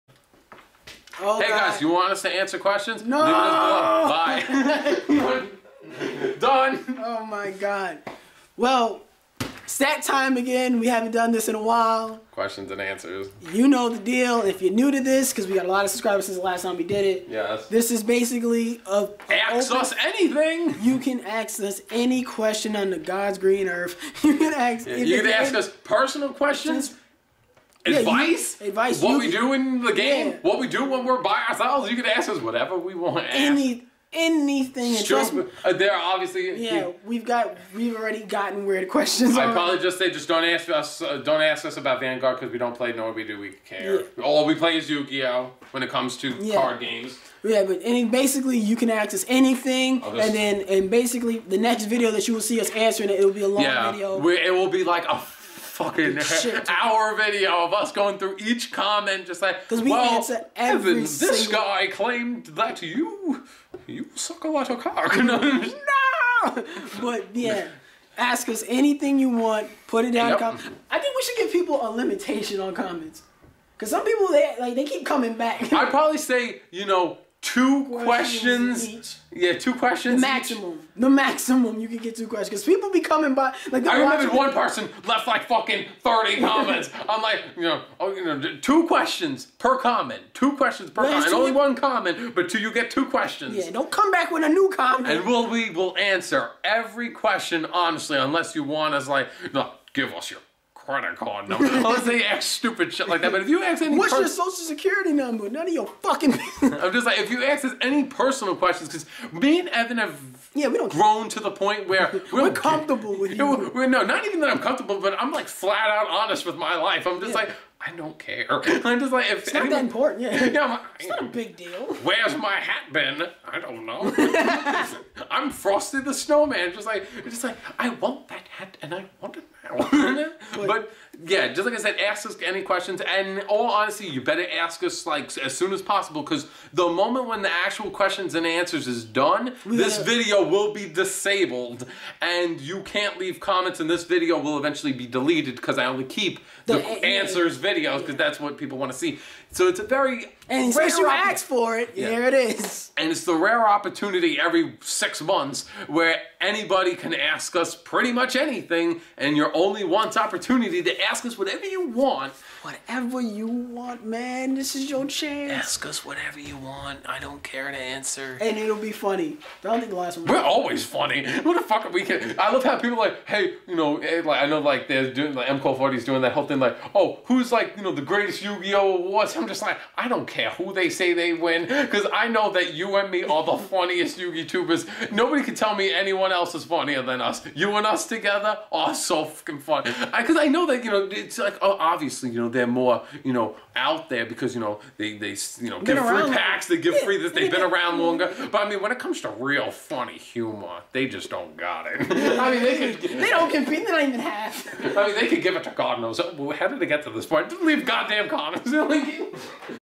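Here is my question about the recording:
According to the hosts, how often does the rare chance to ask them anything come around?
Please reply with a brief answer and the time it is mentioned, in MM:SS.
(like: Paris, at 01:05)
Every 6 months, at 02:34.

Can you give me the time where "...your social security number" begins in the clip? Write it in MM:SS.
01:44.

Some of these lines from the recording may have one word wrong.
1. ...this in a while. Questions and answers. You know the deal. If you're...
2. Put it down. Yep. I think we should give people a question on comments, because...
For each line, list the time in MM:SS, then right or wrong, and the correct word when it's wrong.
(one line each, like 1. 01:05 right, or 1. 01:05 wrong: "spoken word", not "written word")
1. 00:11 right
2. 01:09 wrong: "limitation", not "question".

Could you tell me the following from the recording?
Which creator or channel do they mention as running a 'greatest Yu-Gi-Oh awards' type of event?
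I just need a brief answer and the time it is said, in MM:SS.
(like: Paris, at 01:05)
MCO, at 02:55.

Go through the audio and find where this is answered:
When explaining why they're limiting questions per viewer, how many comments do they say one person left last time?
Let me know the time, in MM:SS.
01:26.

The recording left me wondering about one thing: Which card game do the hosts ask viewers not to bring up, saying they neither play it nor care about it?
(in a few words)
Vanguard.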